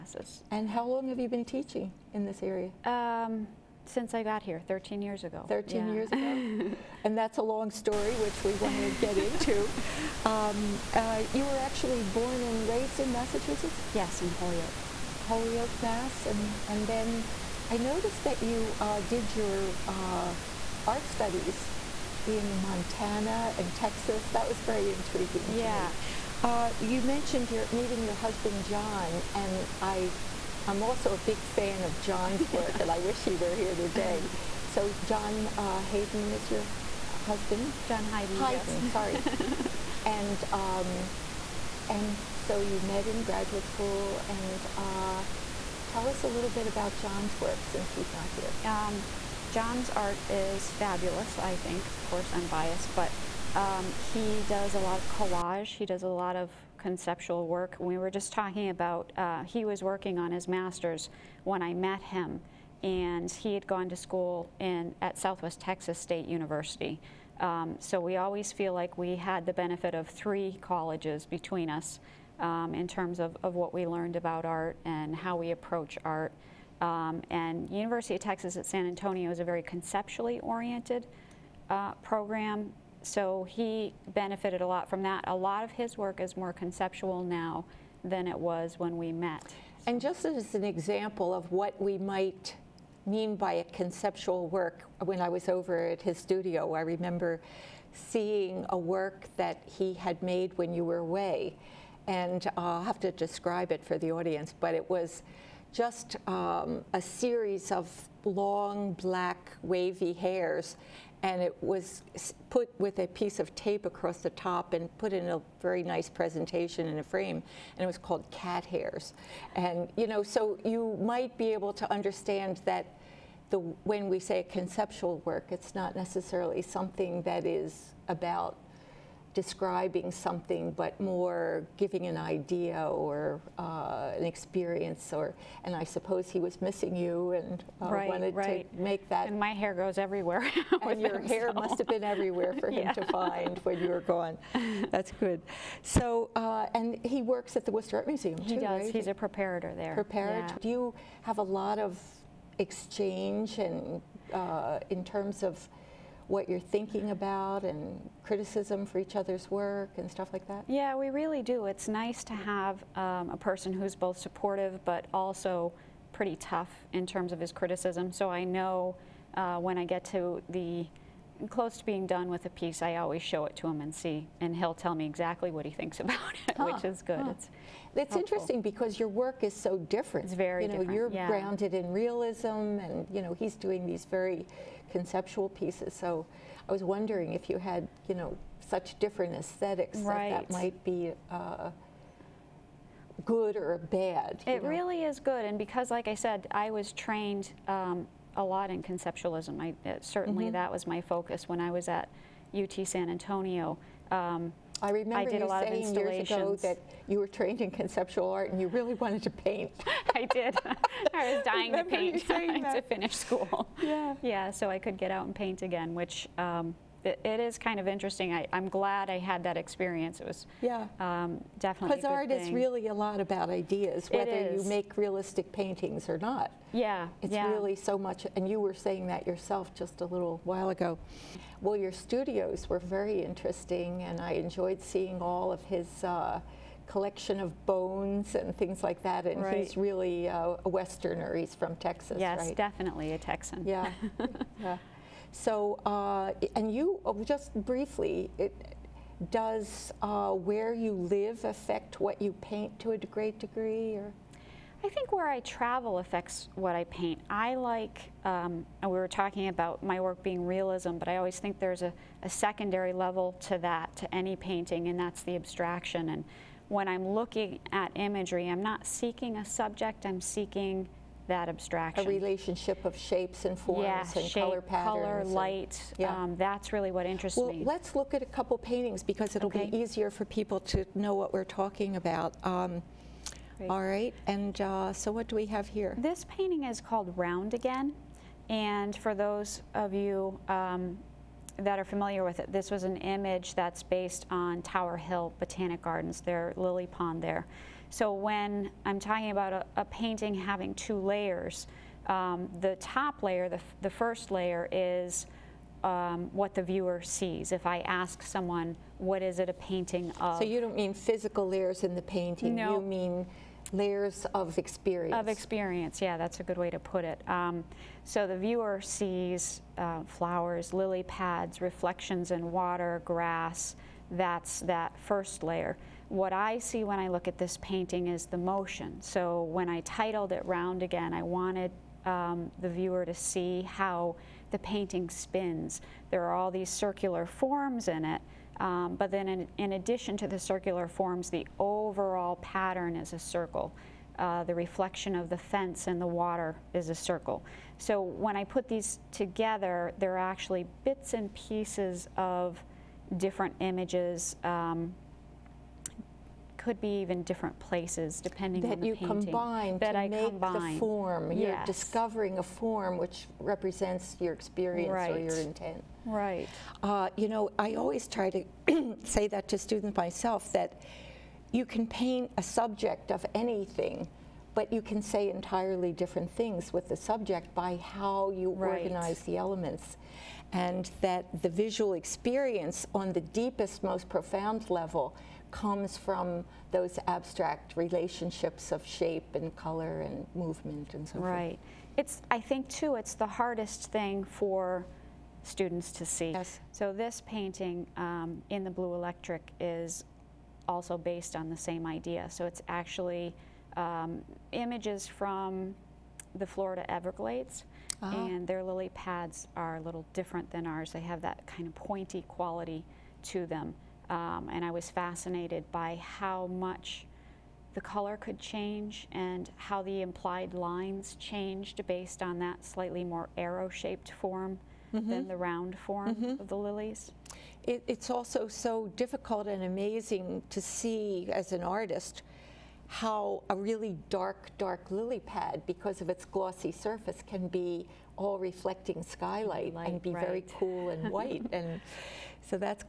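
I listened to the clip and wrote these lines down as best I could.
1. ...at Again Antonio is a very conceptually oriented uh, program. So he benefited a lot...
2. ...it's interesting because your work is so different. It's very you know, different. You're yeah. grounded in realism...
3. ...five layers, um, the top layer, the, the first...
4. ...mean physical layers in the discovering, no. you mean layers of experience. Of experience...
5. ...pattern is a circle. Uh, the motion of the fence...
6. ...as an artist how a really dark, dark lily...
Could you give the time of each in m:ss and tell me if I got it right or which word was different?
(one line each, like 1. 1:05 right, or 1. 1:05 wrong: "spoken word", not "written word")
1. 1:18 wrong: "San", not "Again"
2. 2:57 right
3. 5:00 wrong: "two", not "five"
4. 5:10 wrong: "painting", not "discovering"
5. 5:42 wrong: "reflection", not "motion"
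6. 7:11 right.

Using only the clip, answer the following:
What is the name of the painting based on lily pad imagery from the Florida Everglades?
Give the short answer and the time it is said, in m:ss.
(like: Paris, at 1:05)
Blue Electric, at 6:38.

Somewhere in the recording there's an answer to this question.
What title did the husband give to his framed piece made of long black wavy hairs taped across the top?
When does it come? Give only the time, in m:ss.
1:58.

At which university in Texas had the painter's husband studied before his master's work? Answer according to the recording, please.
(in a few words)
Southwest Texas State University.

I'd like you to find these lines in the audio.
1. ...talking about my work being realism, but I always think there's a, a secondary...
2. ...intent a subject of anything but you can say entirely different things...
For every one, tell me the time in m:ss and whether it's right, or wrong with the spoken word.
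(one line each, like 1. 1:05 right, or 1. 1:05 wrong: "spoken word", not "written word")
1. 4:19 right
2. 6:11 wrong: "paint", not "intent".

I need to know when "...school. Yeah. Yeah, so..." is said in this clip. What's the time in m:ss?
3:33.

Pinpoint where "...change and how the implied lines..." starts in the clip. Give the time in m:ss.
6:58.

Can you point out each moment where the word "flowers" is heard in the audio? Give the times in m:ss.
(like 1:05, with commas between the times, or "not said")
5:20.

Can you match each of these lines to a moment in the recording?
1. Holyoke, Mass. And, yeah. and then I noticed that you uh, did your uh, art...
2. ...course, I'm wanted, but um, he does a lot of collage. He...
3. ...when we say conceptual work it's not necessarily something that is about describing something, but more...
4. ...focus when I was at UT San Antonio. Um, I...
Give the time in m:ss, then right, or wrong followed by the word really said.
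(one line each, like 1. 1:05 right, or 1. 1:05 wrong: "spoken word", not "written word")
1. 0:15 right
2. 0:52 wrong: "biased", not "wanted"
3. 2:03 right
4. 3:21 right.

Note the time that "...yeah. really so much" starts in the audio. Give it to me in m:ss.
3:47.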